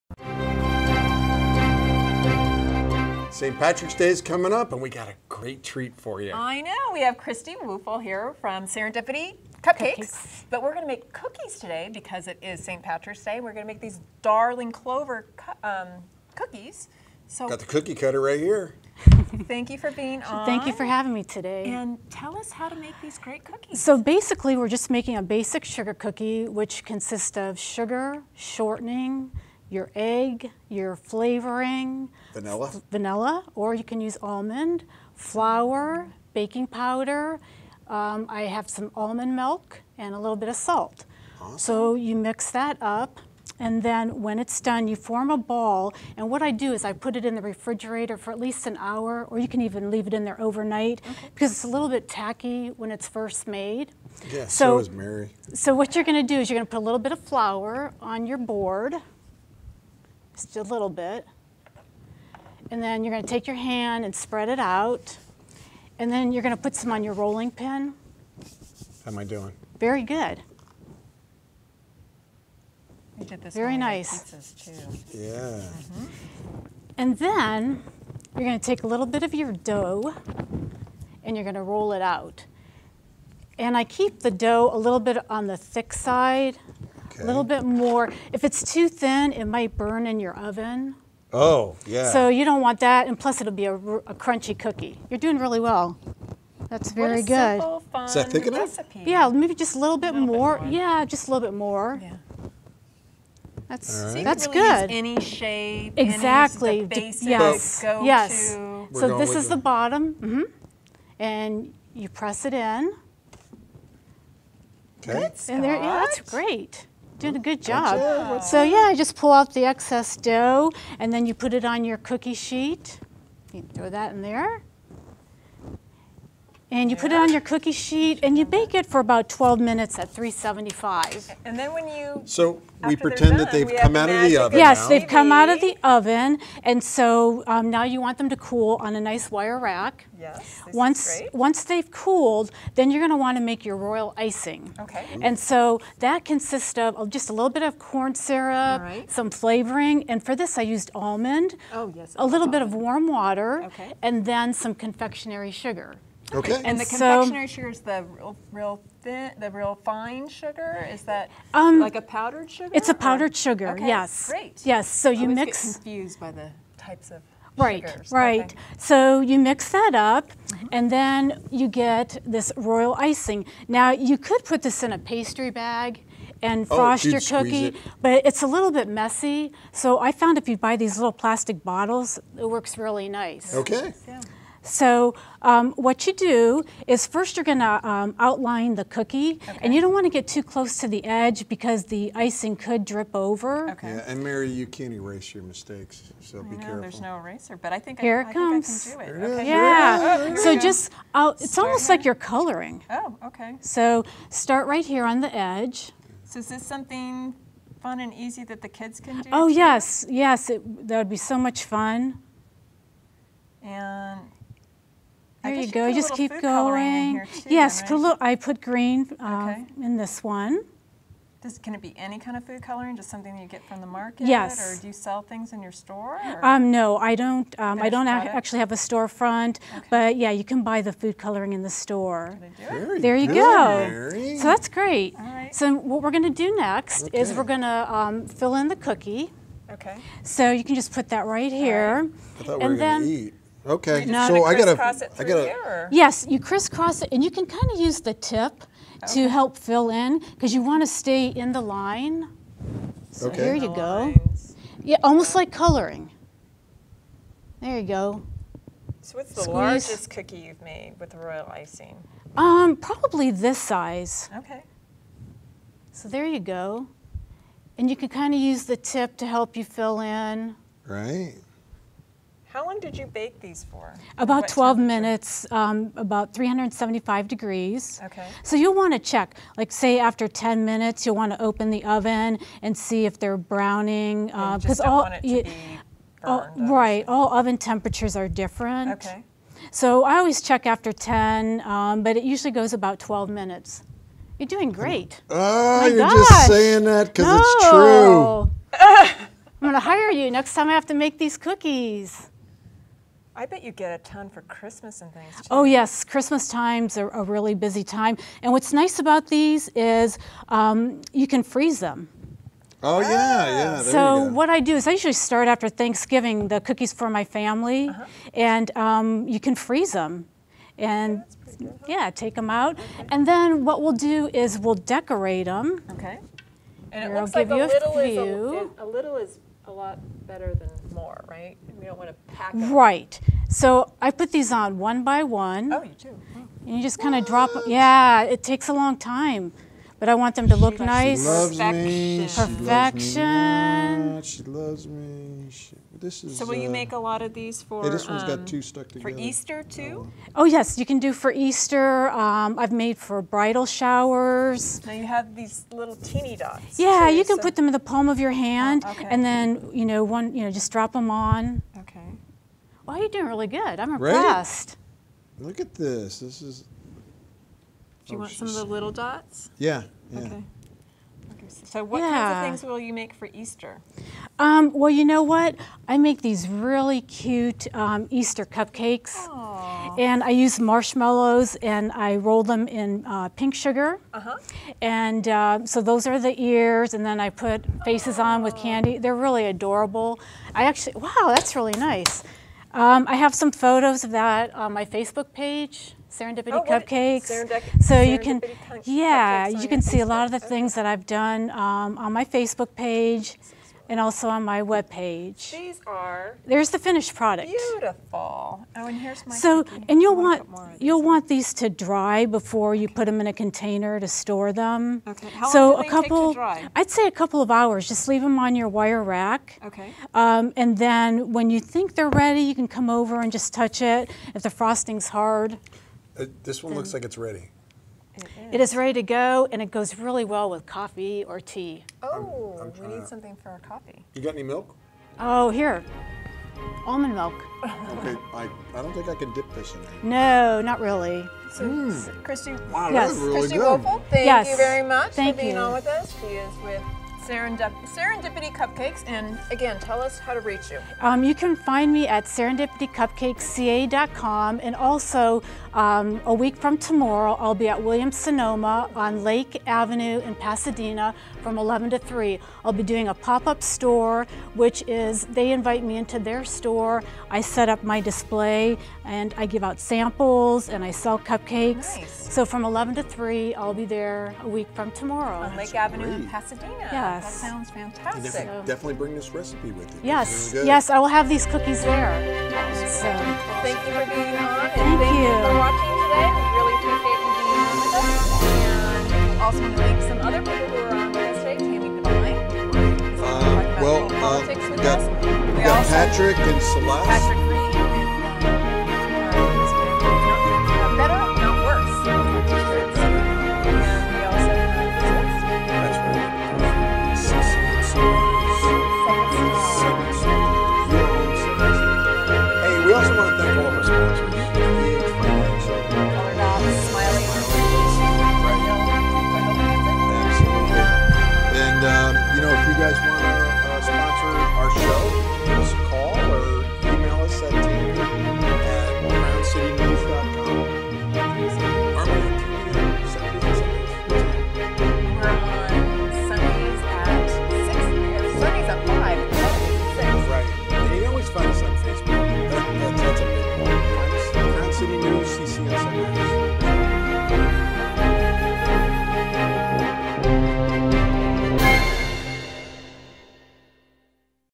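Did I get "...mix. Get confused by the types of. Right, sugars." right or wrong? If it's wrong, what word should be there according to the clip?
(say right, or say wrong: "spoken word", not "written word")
right.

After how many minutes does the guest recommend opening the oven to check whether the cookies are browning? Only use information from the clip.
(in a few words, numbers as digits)
10 minutes.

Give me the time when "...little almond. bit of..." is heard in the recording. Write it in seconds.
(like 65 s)
152 s.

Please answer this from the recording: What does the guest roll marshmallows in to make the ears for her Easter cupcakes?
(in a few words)
pink sugar.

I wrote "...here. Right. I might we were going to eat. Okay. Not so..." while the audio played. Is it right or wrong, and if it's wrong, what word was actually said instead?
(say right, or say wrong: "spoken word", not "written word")
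wrong: "thought", not "might".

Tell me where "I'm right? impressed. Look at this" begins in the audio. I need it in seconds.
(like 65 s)
363 s.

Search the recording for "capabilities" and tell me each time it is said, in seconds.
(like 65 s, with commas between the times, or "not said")
not said.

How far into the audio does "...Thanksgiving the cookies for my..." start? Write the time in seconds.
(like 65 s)
315 s.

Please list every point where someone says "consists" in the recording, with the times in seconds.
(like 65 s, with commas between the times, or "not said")
26 s, 146 s.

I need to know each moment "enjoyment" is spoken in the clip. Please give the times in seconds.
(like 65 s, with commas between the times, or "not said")
not said.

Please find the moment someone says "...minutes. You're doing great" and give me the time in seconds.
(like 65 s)
293 s.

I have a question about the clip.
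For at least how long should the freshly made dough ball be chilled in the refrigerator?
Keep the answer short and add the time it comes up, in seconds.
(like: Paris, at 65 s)
an hour, at 48 s.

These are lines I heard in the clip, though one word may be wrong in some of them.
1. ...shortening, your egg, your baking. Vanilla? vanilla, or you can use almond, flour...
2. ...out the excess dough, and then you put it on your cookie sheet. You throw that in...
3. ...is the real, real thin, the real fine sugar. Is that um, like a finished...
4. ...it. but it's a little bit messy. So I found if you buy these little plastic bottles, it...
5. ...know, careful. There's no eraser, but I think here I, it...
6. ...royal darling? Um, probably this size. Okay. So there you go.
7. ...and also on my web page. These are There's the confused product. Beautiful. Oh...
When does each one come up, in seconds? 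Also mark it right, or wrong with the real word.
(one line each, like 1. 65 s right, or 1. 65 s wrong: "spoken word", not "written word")
1. 28 s wrong: "flavoring", not "baking"
2. 119 s right
3. 157 s wrong: "powdered", not "finished"
4. 177 s right
5. 196 s right
6. 261 s wrong: "icing", not "darling"
7. 403 s wrong: "finished", not "confused".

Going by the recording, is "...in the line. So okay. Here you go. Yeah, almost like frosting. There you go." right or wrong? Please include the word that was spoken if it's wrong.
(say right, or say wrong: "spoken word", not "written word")
wrong: "coloring", not "frosting".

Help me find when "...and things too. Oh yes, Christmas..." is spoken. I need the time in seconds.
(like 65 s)
305 s.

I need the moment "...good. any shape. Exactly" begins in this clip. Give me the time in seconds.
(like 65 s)
104 s.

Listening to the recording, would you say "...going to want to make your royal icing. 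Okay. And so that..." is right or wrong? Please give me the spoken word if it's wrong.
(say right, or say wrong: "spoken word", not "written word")
right.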